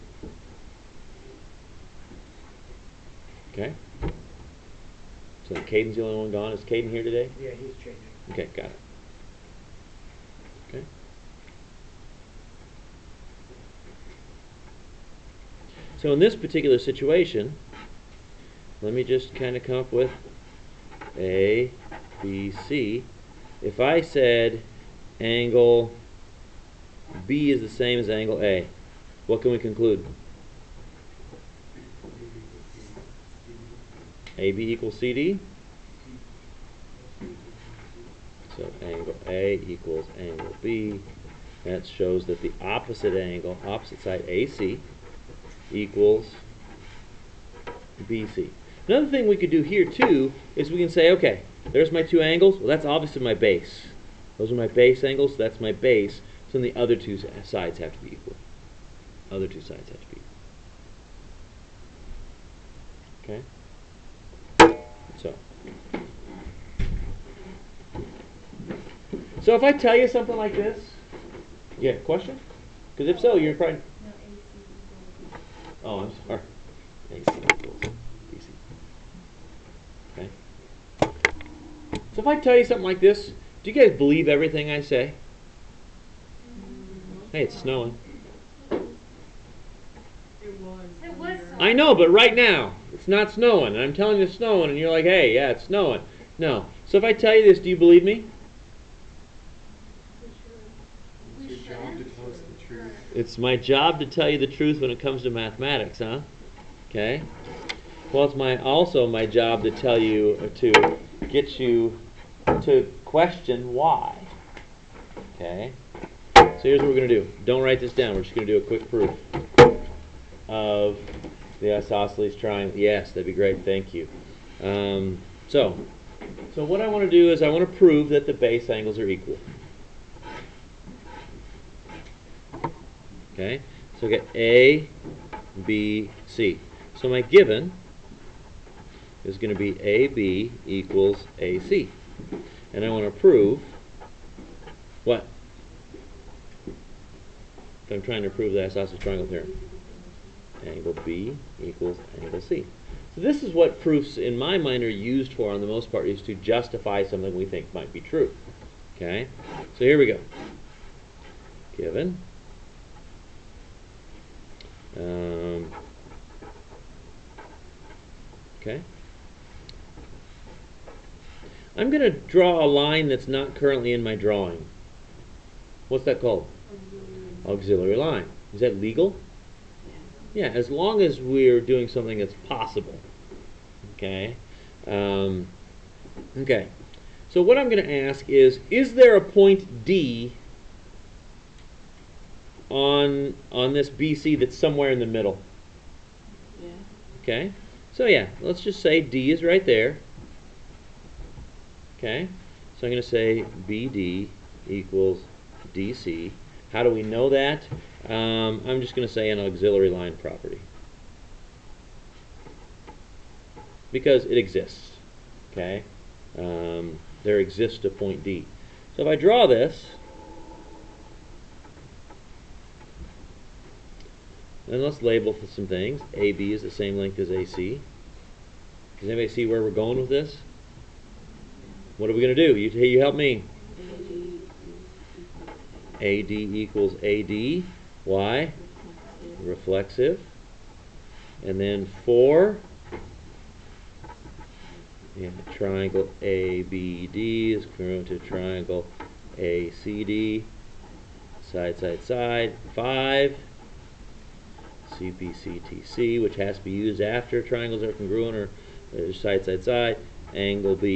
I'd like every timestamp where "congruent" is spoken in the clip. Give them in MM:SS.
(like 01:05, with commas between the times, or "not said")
04:07, 04:17.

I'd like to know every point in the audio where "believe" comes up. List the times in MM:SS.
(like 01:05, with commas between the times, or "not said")
01:23, 01:37.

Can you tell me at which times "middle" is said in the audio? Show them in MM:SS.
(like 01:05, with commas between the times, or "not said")
03:15.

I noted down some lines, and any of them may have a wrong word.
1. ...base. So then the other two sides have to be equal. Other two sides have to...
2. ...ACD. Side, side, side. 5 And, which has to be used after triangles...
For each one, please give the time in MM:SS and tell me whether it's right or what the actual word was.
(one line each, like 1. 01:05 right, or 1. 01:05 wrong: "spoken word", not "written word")
1. 00:55 right
2. 04:09 wrong: "CPCTC", not "And".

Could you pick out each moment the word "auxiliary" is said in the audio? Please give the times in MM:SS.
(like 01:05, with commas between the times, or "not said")
02:57, 03:29.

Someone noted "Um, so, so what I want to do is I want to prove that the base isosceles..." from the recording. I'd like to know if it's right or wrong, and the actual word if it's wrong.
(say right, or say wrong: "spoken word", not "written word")
wrong: "angles", not "isosceles".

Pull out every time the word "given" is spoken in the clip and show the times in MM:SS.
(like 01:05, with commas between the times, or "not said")
02:17, 02:41.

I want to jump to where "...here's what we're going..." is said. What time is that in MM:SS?
01:56.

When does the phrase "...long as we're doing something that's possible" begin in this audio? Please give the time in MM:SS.
03:00.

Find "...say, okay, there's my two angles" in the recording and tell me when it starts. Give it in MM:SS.
00:50.